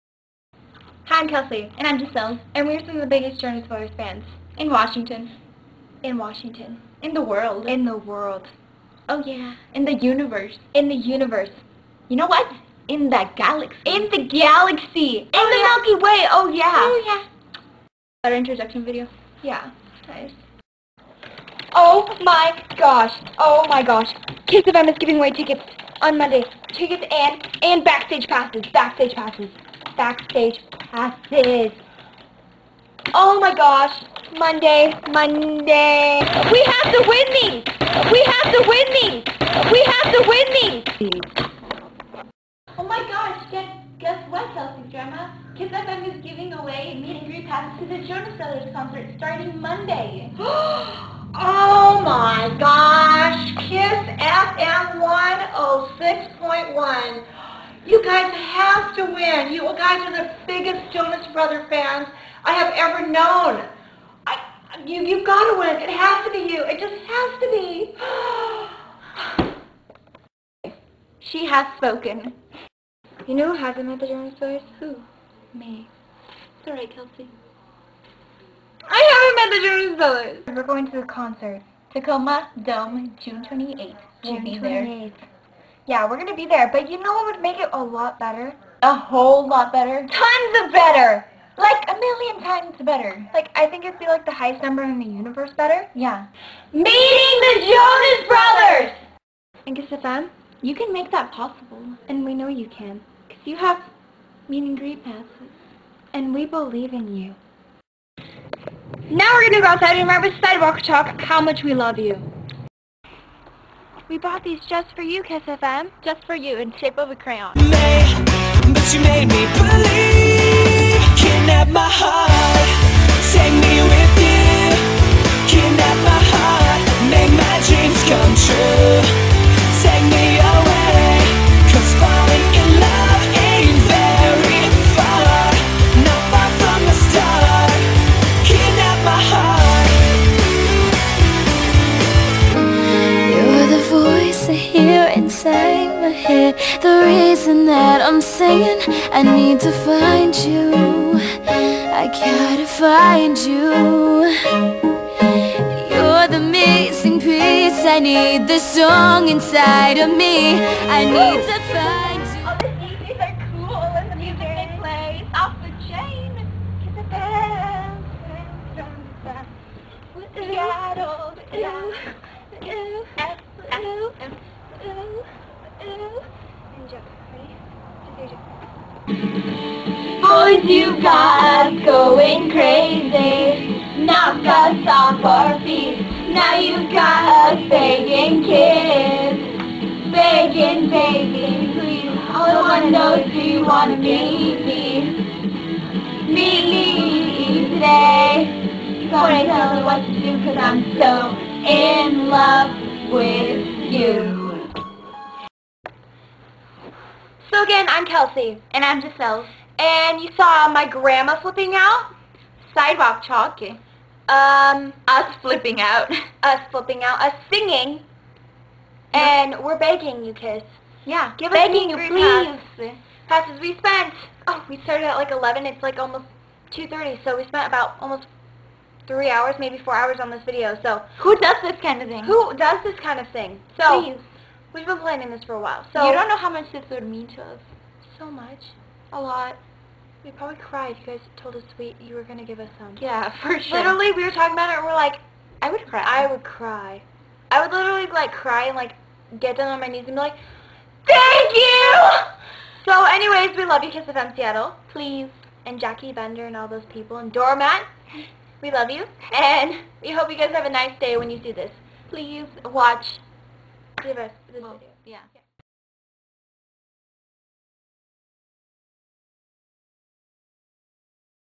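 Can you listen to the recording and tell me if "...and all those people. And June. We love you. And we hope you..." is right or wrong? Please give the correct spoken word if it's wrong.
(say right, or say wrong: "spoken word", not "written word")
wrong: "Doormat", not "June".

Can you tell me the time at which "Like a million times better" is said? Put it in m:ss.
1:31.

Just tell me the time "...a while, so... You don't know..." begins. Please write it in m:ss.
3:55.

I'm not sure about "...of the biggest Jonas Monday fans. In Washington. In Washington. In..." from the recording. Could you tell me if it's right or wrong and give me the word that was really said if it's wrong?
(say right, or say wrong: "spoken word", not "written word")
wrong: "Brothers", not "Monday".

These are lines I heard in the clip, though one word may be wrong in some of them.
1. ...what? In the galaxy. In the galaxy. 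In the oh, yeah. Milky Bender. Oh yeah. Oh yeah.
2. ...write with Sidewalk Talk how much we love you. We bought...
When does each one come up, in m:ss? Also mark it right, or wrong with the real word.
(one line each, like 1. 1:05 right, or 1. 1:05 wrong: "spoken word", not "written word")
1. 0:12 wrong: "Way", not "Bender"
2. 1:50 right.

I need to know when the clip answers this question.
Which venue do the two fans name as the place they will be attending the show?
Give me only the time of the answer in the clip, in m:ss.
1:21.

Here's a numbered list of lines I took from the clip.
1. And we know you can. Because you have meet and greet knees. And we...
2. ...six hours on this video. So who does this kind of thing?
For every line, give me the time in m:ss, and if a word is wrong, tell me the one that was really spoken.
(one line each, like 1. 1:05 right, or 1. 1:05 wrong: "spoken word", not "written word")
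1. 1:42 wrong: "passes", not "knees"
2. 3:49 wrong: "four", not "six".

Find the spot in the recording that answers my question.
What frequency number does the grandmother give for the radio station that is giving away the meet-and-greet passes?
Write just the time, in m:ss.
0:56.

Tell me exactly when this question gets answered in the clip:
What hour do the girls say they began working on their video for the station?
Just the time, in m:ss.
3:45.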